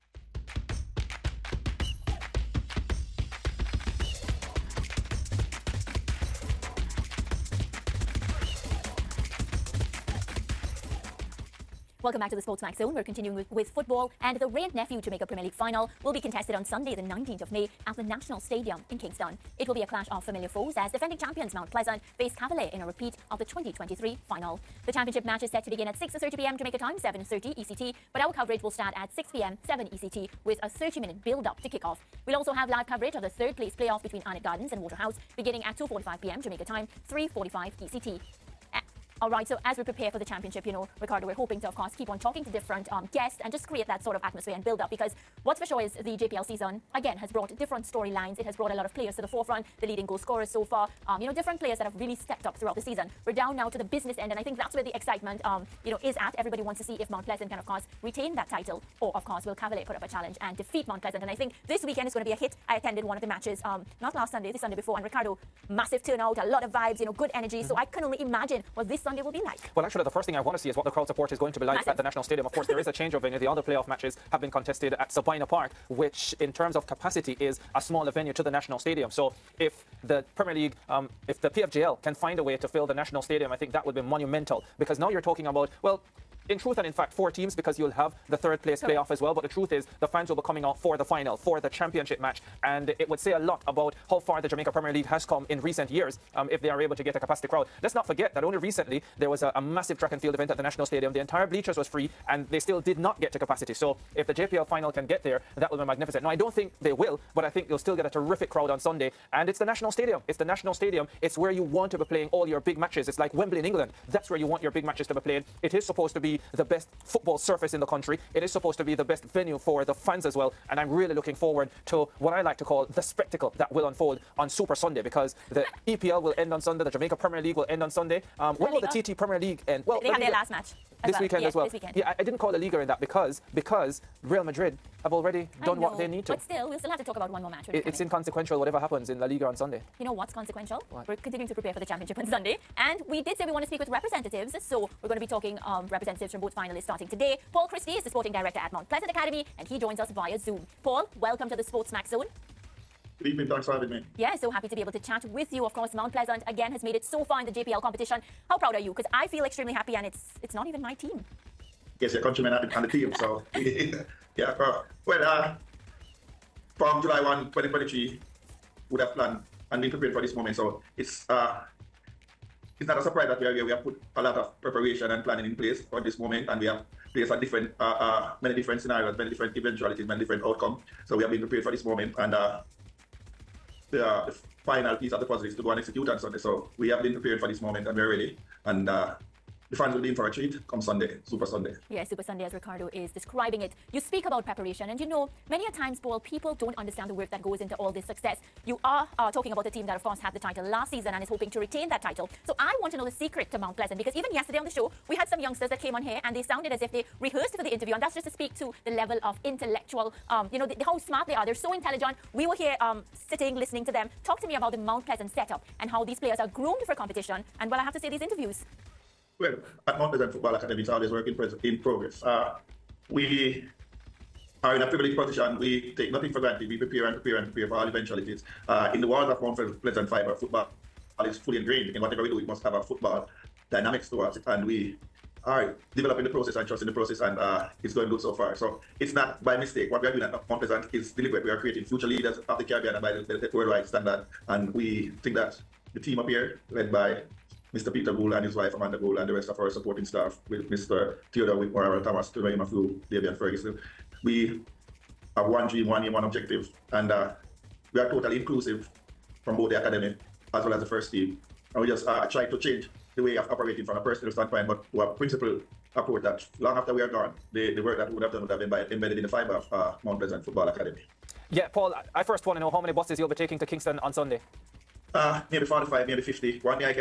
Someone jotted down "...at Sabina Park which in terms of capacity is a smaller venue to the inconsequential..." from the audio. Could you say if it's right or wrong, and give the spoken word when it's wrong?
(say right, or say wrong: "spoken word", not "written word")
wrong: "national", not "inconsequential".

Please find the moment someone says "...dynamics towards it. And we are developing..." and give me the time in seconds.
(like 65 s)
233 s.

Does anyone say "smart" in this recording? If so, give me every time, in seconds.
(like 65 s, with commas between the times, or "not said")
210 s.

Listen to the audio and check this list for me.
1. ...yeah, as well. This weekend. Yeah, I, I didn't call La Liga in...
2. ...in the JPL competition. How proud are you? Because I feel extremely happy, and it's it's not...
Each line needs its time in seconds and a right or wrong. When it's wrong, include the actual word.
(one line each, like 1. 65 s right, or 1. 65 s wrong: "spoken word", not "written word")
1. 131 s right
2. 157 s right.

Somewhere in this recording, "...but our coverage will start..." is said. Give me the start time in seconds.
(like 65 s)
28 s.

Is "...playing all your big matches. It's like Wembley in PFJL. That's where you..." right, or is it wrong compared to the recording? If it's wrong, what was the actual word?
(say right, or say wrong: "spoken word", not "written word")
wrong: "England", not "PFJL".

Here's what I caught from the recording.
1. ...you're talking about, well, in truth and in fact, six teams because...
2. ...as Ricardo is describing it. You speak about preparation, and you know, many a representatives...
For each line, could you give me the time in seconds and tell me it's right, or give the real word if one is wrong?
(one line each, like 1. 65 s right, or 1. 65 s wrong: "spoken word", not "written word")
1. 85 s wrong: "four", not "six"
2. 192 s wrong: "times", not "representatives".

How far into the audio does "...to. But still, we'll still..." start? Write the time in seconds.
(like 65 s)
136 s.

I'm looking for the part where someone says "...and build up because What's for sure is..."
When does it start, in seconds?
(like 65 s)
44 s.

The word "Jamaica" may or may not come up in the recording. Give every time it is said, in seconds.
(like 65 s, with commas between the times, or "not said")
15 s, 26 s, 36 s, 94 s, 126 s.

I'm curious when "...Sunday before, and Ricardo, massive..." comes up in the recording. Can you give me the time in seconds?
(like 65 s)
64 s.